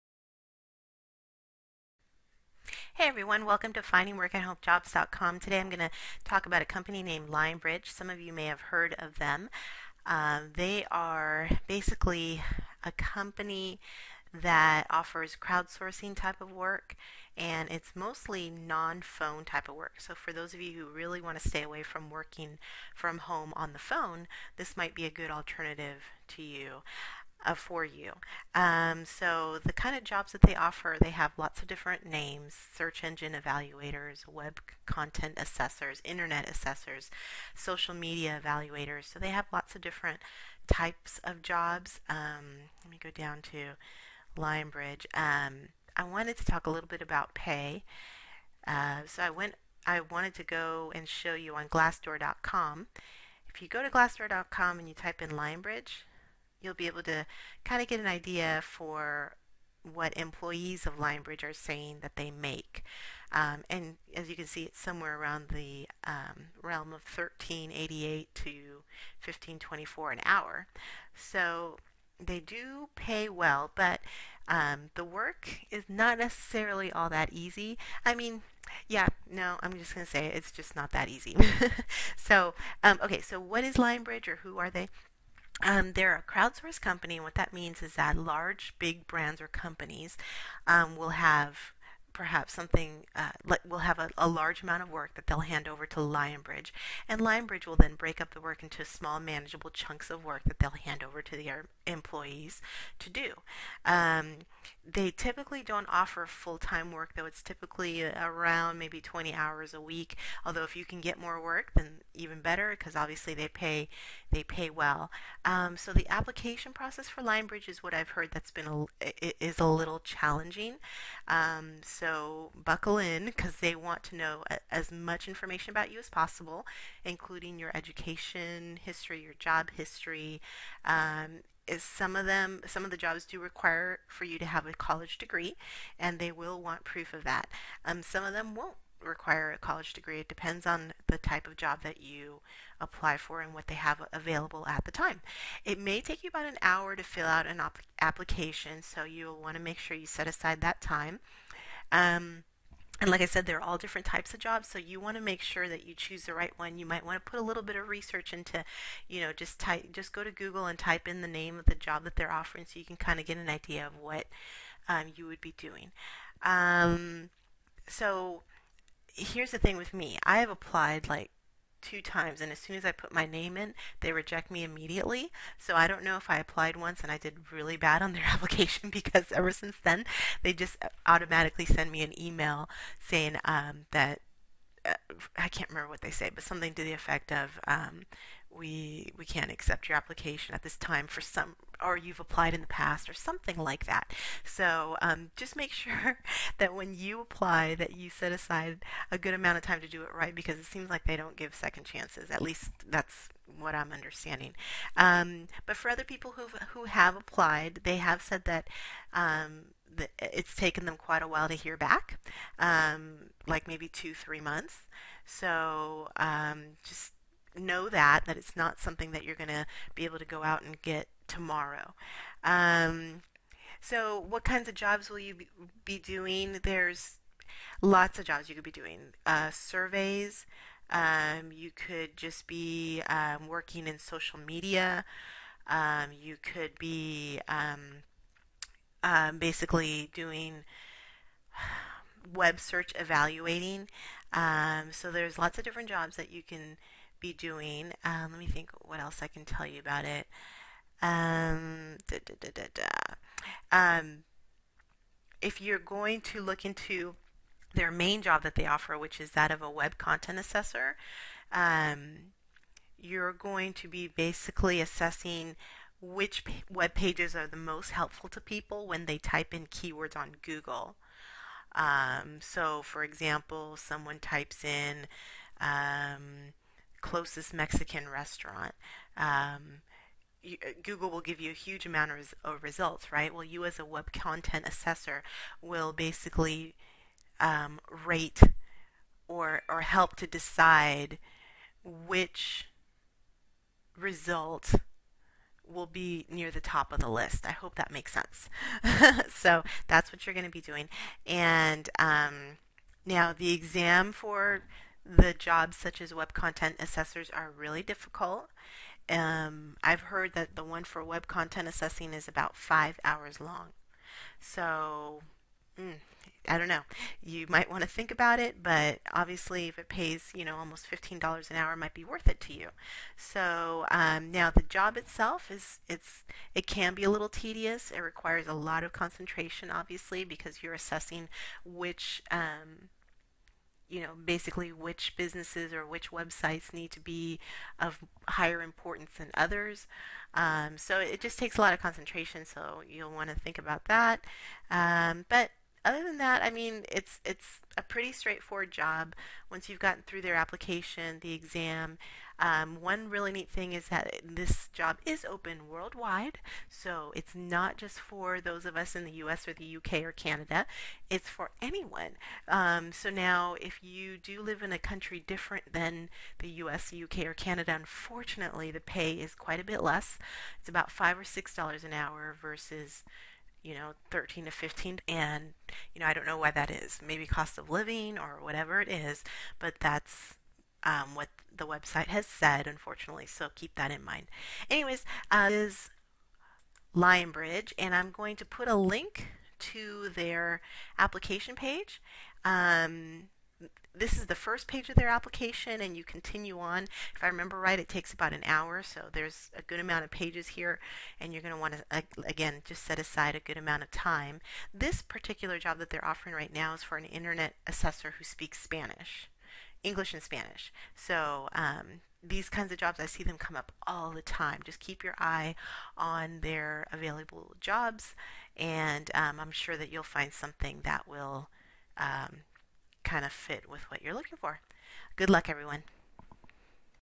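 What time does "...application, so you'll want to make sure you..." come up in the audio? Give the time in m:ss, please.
2:28.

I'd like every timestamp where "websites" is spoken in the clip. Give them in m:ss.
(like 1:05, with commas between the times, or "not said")
5:36, 6:21.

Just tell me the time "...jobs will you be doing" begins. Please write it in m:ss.
3:44.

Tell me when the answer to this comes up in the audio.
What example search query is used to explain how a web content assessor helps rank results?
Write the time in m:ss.
4:37.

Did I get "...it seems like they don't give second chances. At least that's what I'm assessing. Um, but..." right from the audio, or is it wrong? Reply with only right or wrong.
wrong.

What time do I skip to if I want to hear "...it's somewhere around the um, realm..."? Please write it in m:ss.
1:04.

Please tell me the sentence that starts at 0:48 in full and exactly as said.
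Uh, so, I went I wanted to go and show you on glassdoor.com.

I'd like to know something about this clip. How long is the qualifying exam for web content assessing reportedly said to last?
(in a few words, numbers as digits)
5 hours.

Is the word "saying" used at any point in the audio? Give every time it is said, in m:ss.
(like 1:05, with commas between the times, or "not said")
1:01, 3:02.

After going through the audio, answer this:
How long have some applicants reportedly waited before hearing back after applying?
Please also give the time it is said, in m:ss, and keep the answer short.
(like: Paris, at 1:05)
2 to 3 months, at 3:33.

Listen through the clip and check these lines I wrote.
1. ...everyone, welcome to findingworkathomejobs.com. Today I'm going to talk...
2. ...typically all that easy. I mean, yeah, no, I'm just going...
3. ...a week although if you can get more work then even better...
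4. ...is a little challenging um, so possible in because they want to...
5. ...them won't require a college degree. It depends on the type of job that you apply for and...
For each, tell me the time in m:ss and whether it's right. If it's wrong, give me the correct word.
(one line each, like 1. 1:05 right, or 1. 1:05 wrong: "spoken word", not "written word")
1. 0:03 right
2. 1:16 wrong: "necessarily", not "typically"
3. 1:49 right
4. 1:59 wrong: "buckle", not "possible"
5. 2:18 right.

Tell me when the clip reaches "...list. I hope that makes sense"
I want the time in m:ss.
4:57.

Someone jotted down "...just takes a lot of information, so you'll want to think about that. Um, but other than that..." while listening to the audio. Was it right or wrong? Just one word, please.
wrong.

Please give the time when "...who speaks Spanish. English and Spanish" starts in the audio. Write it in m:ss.
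6:48.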